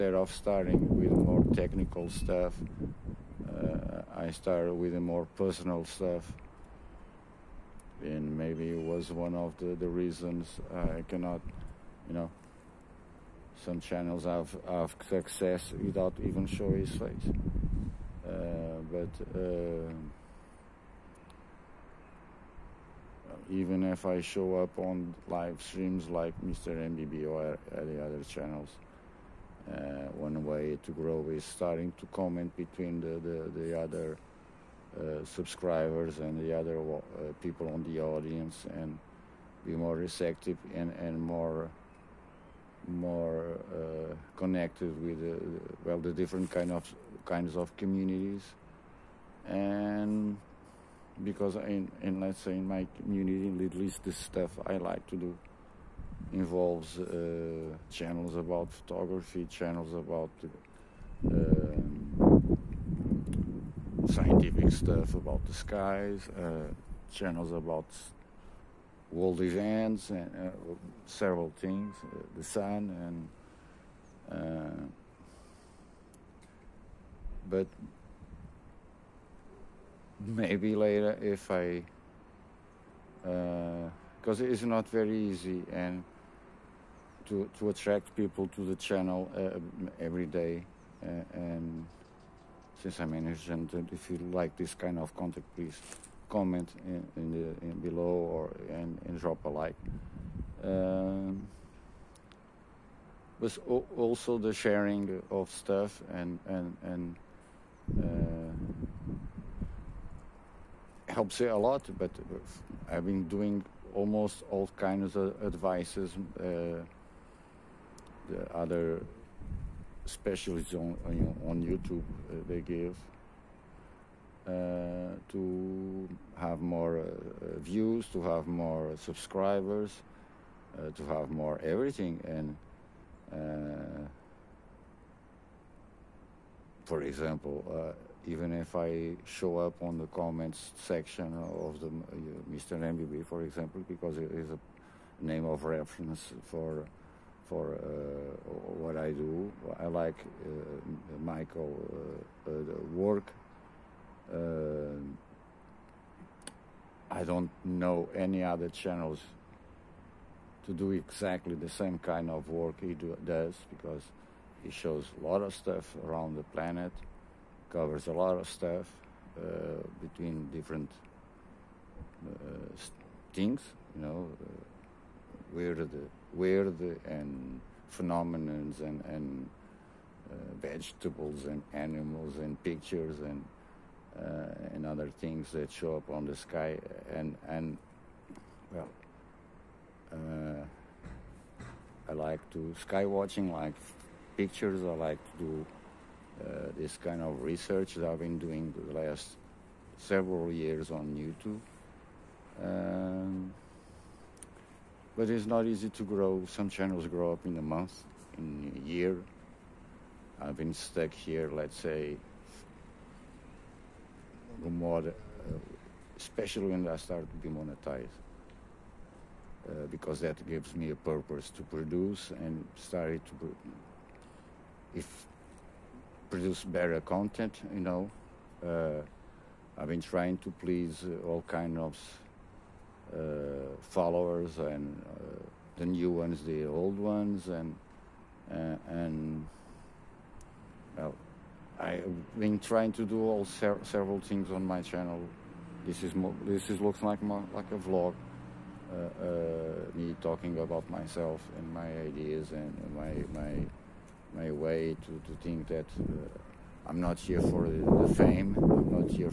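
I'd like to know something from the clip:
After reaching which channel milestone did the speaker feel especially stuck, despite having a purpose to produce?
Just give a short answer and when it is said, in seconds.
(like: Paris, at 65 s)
monetized, at 217 s.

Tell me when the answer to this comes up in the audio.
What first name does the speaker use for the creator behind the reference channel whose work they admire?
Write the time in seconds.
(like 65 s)
151 s.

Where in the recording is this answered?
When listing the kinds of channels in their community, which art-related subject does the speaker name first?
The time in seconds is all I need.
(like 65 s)
58 s.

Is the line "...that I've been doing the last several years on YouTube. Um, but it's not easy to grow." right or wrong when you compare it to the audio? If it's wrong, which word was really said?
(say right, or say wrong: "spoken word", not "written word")
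right.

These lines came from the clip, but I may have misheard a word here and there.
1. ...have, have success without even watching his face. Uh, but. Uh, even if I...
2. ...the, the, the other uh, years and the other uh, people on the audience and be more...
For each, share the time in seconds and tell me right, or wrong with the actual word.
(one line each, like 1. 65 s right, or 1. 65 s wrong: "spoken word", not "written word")
1. 14 s wrong: "showing", not "watching"
2. 33 s wrong: "subscribers", not "years".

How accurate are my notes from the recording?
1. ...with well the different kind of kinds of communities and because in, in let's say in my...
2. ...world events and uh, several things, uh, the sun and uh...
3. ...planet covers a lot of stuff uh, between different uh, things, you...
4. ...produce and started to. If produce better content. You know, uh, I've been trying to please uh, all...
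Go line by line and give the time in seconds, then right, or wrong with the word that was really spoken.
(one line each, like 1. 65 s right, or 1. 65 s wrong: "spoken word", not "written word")
1. 45 s right
2. 69 s right
3. 166 s right
4. 221 s right.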